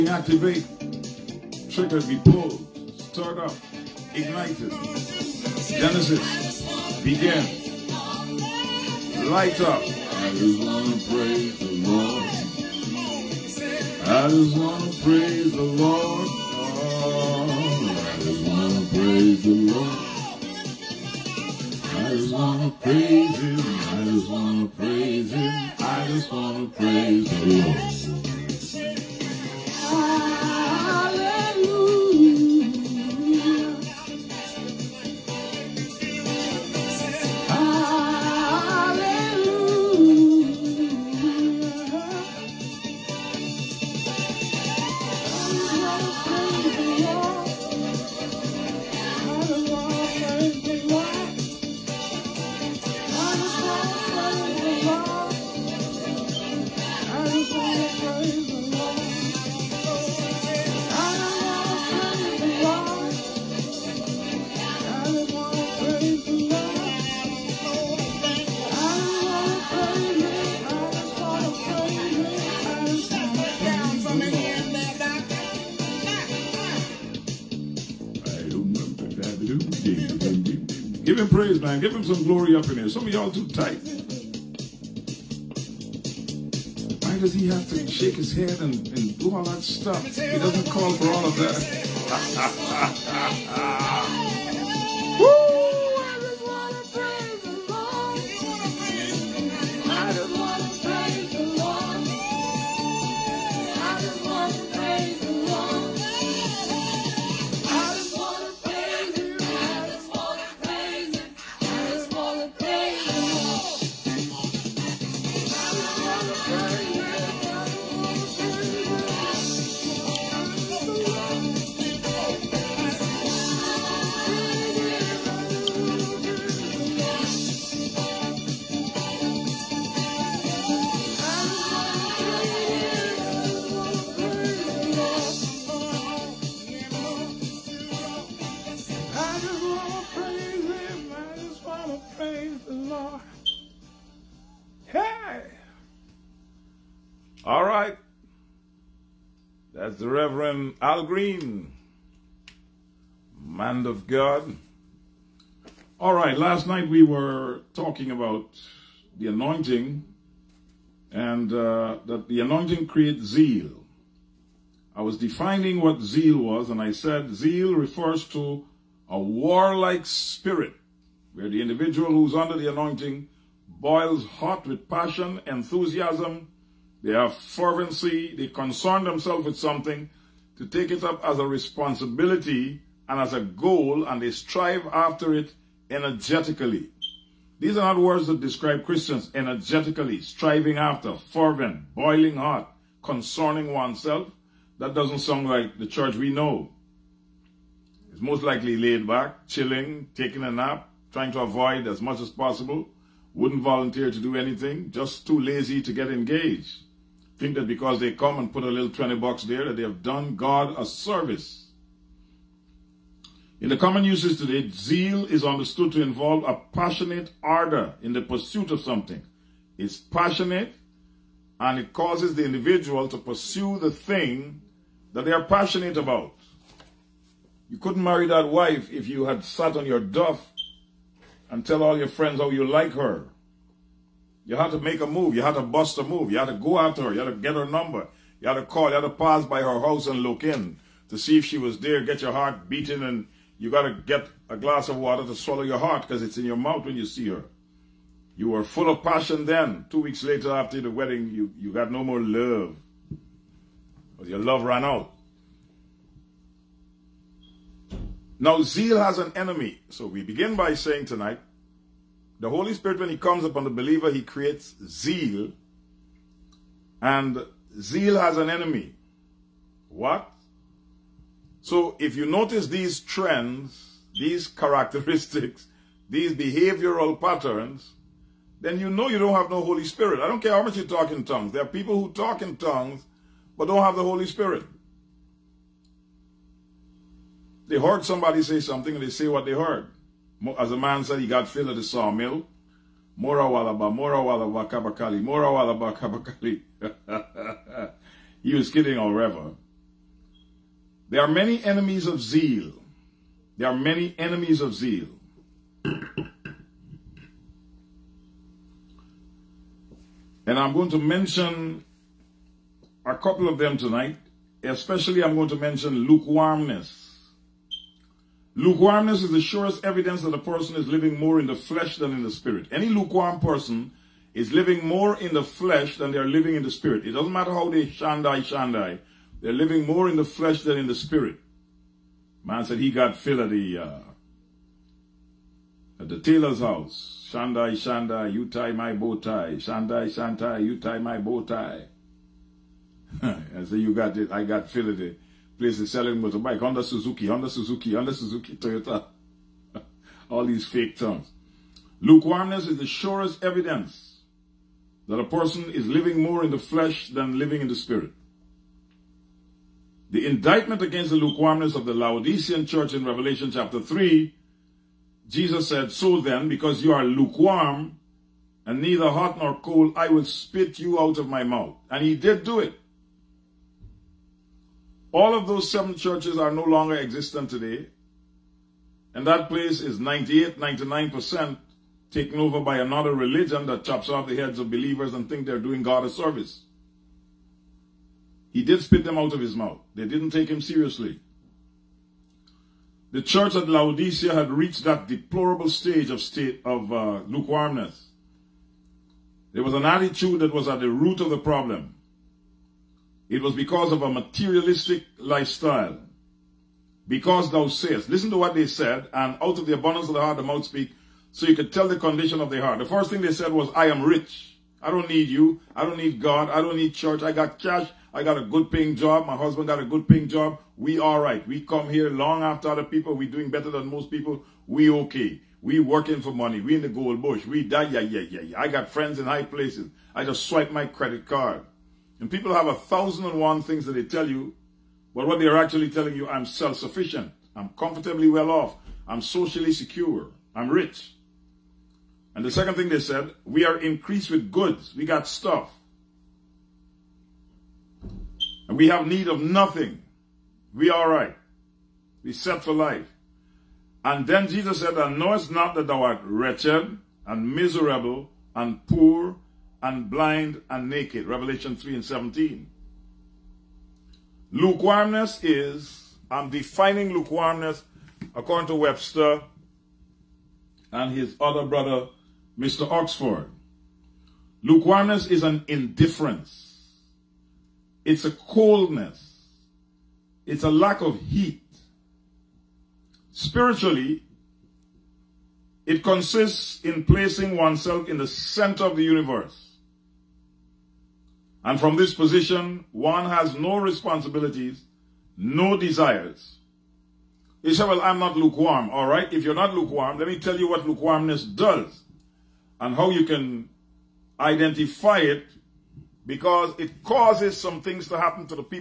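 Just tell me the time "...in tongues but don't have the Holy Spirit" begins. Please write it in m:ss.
4:42.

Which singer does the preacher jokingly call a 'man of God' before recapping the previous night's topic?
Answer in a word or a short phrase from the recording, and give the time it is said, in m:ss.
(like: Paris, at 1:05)
Al Green, at 2:30.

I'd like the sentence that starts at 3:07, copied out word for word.
These are not words that describe Christians energetically, striving after, fervent, boiling hot, concerning oneself.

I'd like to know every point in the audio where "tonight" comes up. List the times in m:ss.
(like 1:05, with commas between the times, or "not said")
4:21, 5:13.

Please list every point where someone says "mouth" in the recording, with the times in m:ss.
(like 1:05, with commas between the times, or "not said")
4:06, 6:11, 6:29, 6:50.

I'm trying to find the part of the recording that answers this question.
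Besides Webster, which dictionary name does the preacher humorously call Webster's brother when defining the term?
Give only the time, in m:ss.
7:52.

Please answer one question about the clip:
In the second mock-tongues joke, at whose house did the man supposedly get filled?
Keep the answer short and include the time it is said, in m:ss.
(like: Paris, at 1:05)
the tailor's, at 5:36.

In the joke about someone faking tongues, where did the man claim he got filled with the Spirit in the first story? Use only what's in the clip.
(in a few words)
the sawmill.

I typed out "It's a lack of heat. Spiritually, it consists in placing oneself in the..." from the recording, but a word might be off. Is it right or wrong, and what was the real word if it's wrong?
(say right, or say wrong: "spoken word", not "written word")
right.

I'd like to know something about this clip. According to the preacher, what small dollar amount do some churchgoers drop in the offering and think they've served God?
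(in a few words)
$20.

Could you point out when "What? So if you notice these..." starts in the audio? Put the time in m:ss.
4:29.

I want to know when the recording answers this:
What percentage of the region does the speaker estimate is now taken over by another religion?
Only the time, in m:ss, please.
6:20.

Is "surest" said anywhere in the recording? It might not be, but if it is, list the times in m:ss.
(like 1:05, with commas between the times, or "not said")
5:19, 5:52.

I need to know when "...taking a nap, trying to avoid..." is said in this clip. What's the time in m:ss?
3:20.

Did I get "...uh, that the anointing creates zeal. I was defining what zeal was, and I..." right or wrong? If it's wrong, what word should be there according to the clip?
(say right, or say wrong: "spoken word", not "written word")
right.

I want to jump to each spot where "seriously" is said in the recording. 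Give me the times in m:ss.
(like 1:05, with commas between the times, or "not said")
6:30.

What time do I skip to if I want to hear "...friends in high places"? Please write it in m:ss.
7:08.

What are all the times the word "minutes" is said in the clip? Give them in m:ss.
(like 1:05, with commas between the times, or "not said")
not said.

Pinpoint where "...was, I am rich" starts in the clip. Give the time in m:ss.
6:53.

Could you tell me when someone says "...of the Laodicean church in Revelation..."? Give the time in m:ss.
6:01.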